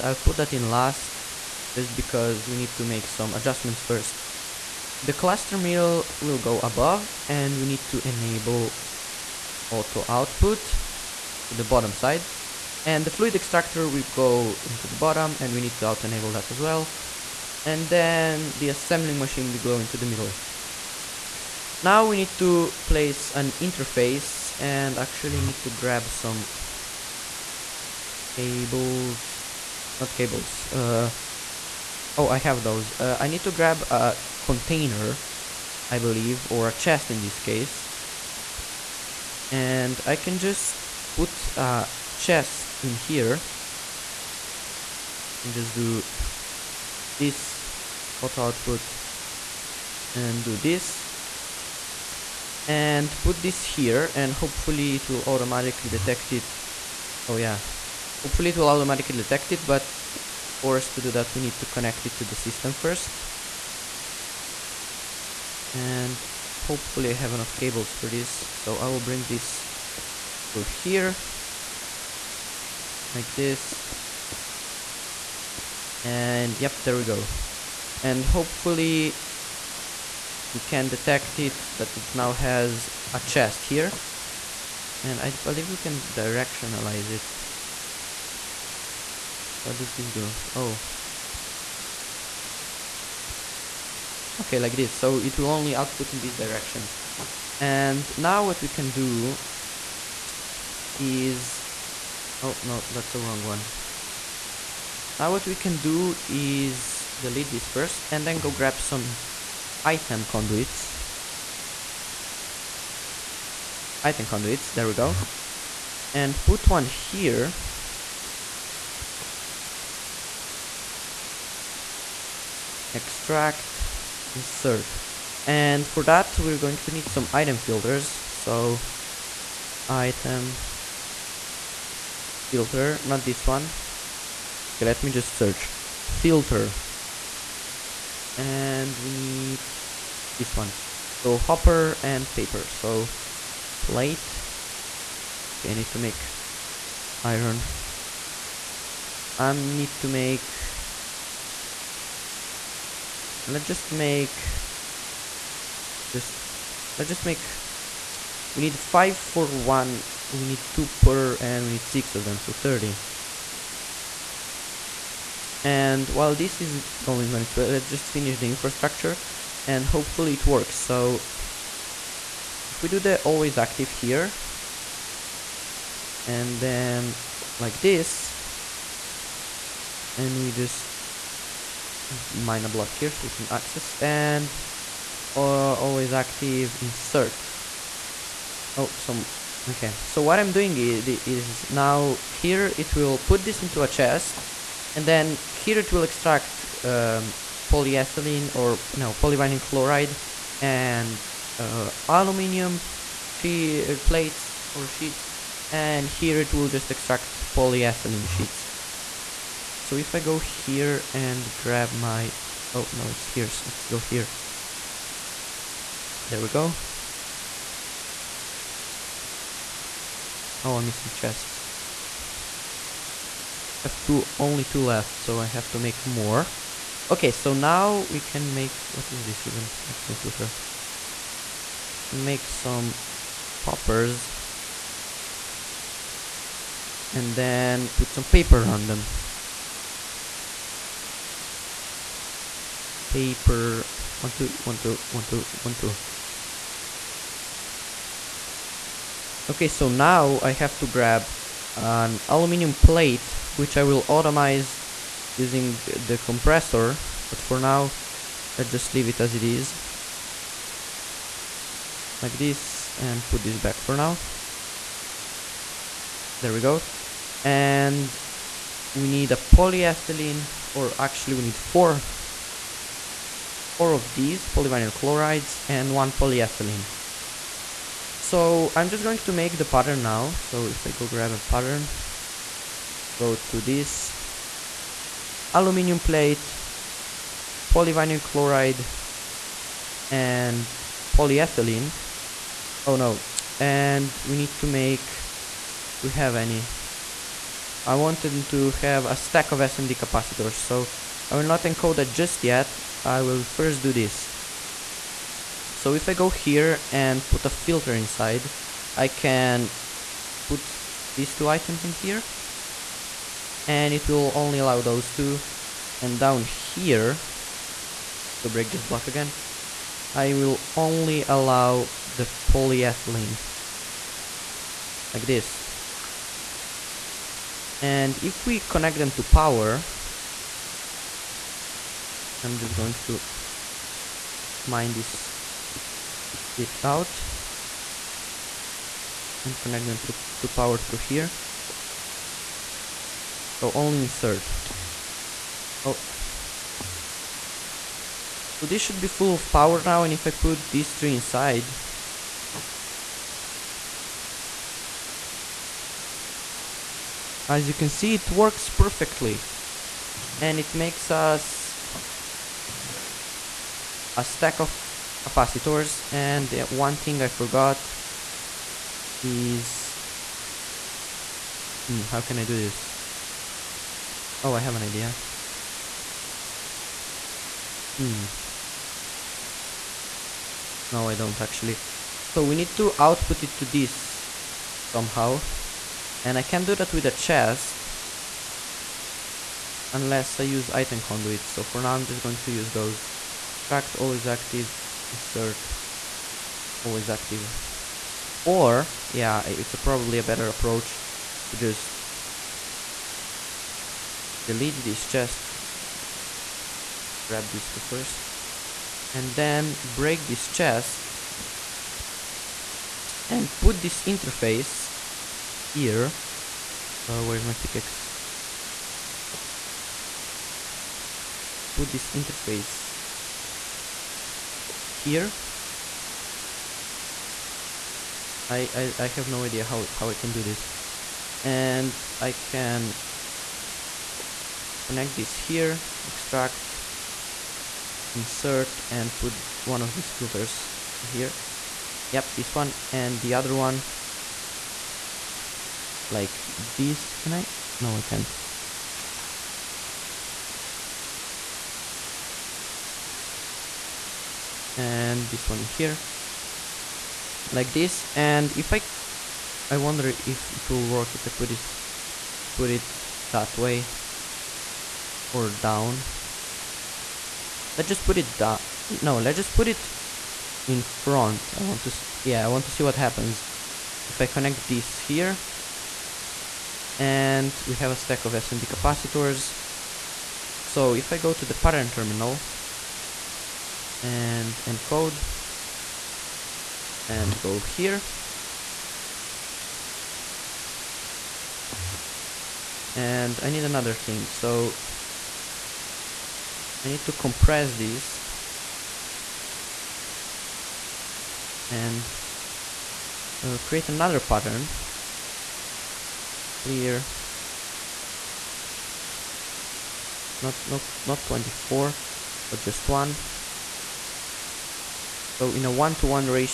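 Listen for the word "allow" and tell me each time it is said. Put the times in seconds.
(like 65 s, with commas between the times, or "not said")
314 s, 321 s.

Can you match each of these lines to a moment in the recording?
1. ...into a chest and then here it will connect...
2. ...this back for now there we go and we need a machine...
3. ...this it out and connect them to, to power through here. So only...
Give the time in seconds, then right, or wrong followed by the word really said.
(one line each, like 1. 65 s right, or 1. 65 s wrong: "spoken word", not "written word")
1. 193 s wrong: "extract", not "connect"
2. 263 s wrong: "polyethylene", not "machine"
3. 334 s right.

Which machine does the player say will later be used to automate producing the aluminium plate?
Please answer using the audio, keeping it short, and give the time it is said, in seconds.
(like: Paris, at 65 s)
compressor, at 256 s.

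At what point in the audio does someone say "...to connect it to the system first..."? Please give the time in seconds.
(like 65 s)
61 s.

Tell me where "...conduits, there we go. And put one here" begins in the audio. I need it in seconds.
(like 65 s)
114 s.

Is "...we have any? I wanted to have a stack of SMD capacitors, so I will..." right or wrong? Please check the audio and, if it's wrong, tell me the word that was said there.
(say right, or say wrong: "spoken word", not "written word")
right.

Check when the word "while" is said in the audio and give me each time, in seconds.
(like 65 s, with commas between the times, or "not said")
166 s.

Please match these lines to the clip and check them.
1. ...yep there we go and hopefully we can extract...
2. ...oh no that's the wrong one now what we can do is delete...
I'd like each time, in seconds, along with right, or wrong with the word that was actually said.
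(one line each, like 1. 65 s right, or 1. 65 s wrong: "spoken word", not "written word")
1. 76 s wrong: "detect", not "extract"
2. 102 s right.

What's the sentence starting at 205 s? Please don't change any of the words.
And here it will just extract polyethylene sheets.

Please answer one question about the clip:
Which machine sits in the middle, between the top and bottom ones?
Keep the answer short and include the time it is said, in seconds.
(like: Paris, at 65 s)
assembling machine, at 18 s.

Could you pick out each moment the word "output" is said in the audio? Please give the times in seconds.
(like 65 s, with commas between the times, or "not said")
10 s, 48 s, 95 s, 382 s.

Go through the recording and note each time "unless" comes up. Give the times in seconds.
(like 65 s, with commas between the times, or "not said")
389 s.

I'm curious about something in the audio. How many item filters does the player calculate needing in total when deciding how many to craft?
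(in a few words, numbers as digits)
30.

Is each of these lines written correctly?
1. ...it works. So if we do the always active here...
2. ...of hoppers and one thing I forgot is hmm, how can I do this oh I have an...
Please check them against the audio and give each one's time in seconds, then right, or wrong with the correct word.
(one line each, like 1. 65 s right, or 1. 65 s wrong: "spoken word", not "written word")
1. 170 s right
2. 364 s wrong: "capacitors", not "hoppers".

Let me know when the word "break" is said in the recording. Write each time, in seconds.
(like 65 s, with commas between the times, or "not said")
318 s, 409 s.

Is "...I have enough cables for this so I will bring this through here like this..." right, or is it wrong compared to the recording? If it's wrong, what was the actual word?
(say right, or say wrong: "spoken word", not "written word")
right.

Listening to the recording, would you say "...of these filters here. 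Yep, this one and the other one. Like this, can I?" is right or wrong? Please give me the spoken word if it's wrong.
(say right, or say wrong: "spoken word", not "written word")
right.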